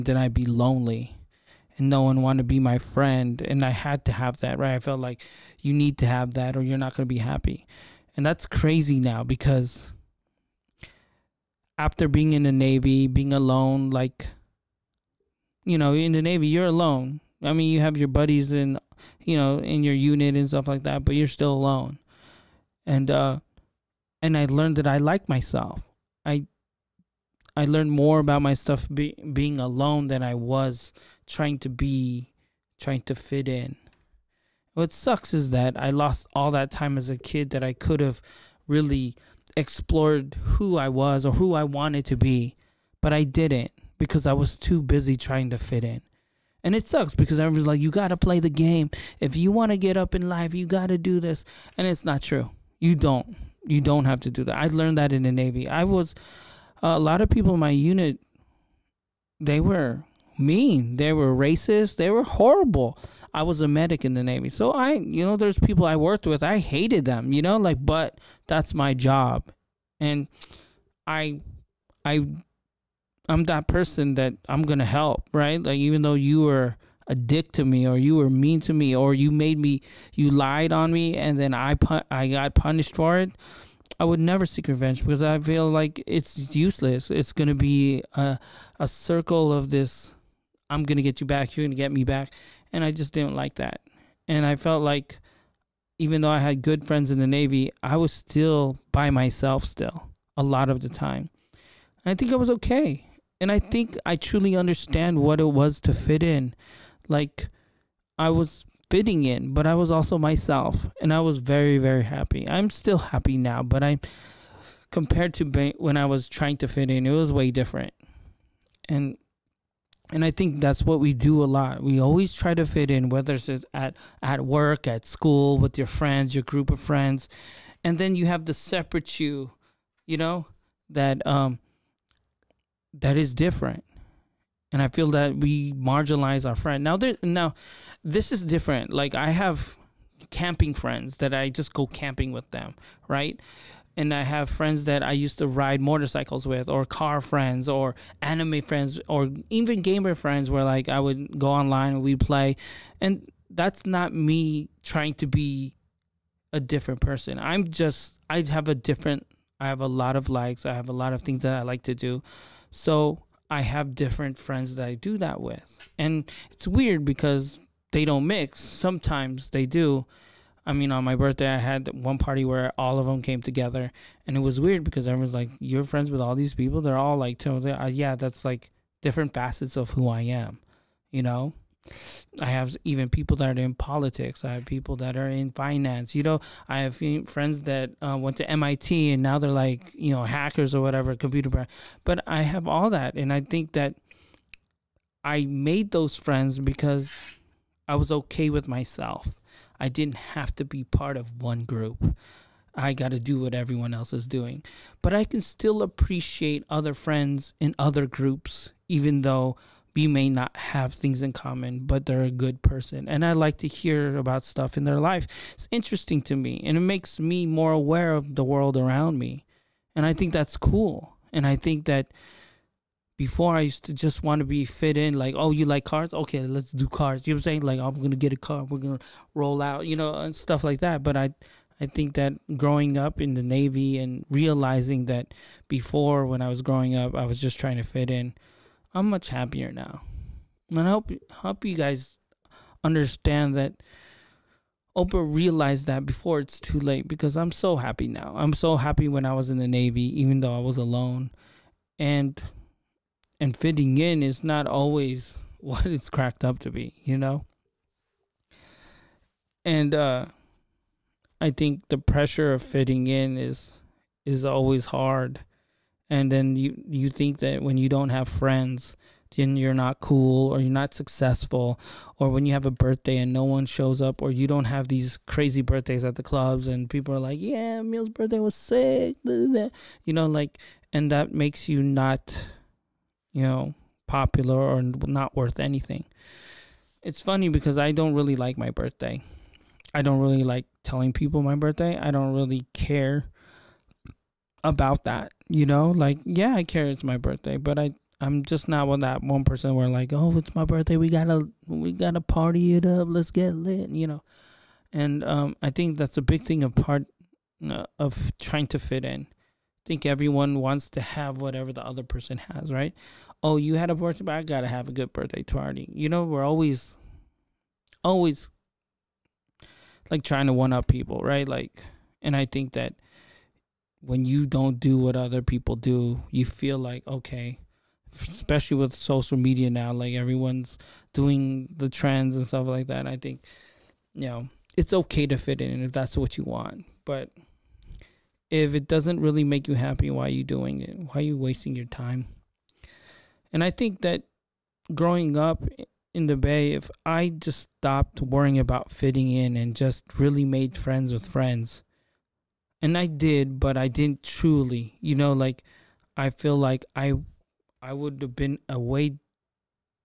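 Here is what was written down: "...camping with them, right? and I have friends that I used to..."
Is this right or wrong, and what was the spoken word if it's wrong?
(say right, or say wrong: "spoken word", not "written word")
right.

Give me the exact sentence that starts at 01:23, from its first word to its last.
I would never seek revenge because I feel like it's useless.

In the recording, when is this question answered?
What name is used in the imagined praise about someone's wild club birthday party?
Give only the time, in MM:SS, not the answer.
04:37.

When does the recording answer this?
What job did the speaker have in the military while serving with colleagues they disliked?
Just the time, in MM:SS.
01:03.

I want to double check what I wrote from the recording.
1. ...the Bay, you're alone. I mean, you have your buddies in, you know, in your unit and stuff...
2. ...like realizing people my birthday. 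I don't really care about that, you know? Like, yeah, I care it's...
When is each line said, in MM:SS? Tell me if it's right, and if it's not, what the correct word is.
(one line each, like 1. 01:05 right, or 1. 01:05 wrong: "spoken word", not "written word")
1. 00:16 wrong: "Navy", not "Bay"
2. 04:50 wrong: "telling", not "realizing".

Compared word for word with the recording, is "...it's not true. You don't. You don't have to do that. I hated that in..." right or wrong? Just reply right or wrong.
wrong.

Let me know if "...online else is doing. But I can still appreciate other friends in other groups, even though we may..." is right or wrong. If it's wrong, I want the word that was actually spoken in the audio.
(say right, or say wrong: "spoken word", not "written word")
wrong: "everyone", not "online".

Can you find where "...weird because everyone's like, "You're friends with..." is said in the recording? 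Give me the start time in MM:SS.
02:54.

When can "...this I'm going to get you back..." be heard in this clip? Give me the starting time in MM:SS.
01:29.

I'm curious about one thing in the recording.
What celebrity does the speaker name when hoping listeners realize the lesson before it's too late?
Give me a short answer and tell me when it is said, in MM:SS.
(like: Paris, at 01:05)
Oprah, at 04:04.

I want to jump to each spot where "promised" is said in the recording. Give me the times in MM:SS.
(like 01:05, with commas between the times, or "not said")
not said.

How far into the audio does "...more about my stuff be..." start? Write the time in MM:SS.
00:27.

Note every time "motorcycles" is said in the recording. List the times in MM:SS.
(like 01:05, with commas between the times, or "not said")
02:25.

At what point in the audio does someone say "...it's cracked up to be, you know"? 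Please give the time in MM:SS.
04:15.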